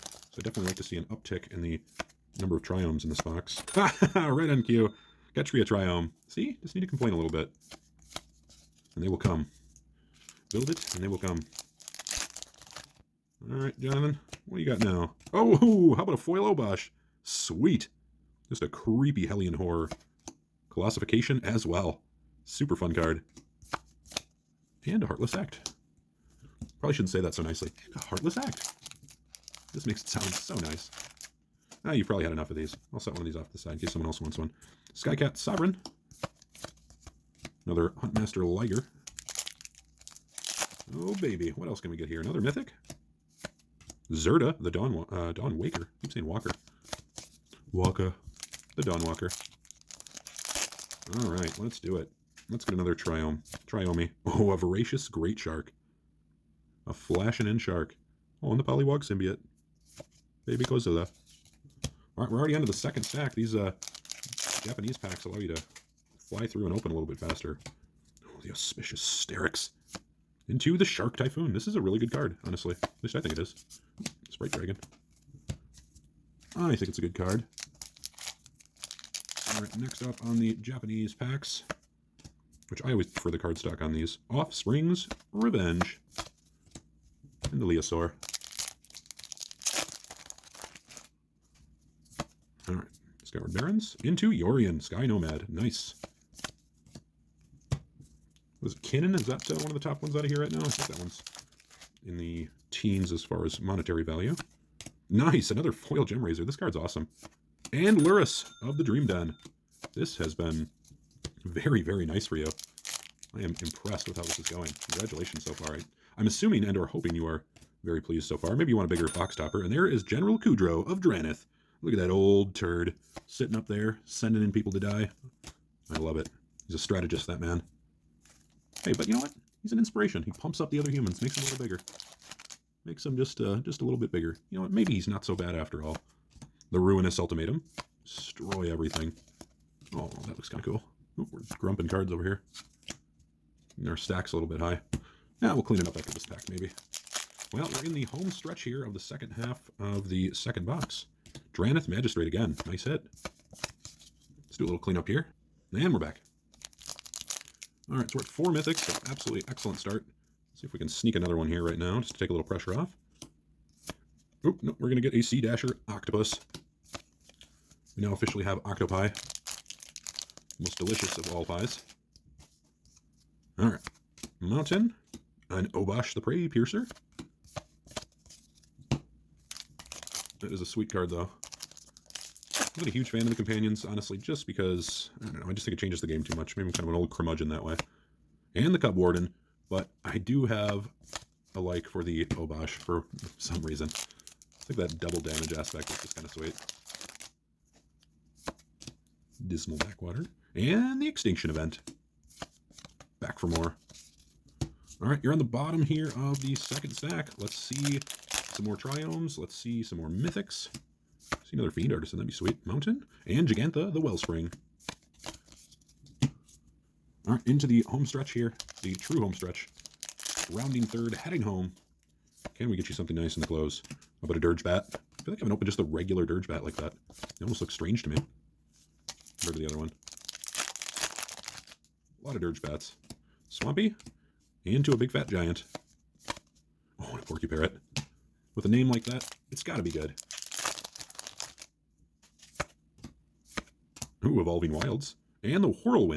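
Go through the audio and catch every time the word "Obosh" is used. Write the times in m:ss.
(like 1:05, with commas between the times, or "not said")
0:16, 2:55, 3:12.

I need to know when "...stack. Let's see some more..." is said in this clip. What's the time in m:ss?
3:26.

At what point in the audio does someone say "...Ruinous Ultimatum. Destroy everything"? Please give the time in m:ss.
2:16.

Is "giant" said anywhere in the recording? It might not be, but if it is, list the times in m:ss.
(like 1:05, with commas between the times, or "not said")
3:55.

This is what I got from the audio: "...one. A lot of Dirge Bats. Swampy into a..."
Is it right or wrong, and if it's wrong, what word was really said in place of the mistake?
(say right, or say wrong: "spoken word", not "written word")
right.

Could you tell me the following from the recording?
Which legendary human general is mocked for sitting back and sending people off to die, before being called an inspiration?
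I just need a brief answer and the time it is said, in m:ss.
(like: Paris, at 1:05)
General Kudro of Drannith, at 2:00.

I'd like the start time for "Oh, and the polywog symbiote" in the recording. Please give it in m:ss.
0:58.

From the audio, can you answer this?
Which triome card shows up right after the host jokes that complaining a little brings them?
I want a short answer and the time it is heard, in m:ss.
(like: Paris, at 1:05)
Ketria Triome, at 0:05.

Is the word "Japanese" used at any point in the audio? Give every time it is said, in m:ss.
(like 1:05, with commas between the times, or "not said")
1:04, 1:20.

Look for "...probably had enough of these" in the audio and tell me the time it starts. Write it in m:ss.
0:32.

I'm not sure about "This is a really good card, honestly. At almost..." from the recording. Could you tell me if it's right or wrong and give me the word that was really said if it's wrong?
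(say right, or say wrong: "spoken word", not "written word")
wrong: "least", not "almost".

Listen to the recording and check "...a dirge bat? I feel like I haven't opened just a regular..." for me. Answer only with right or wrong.
right.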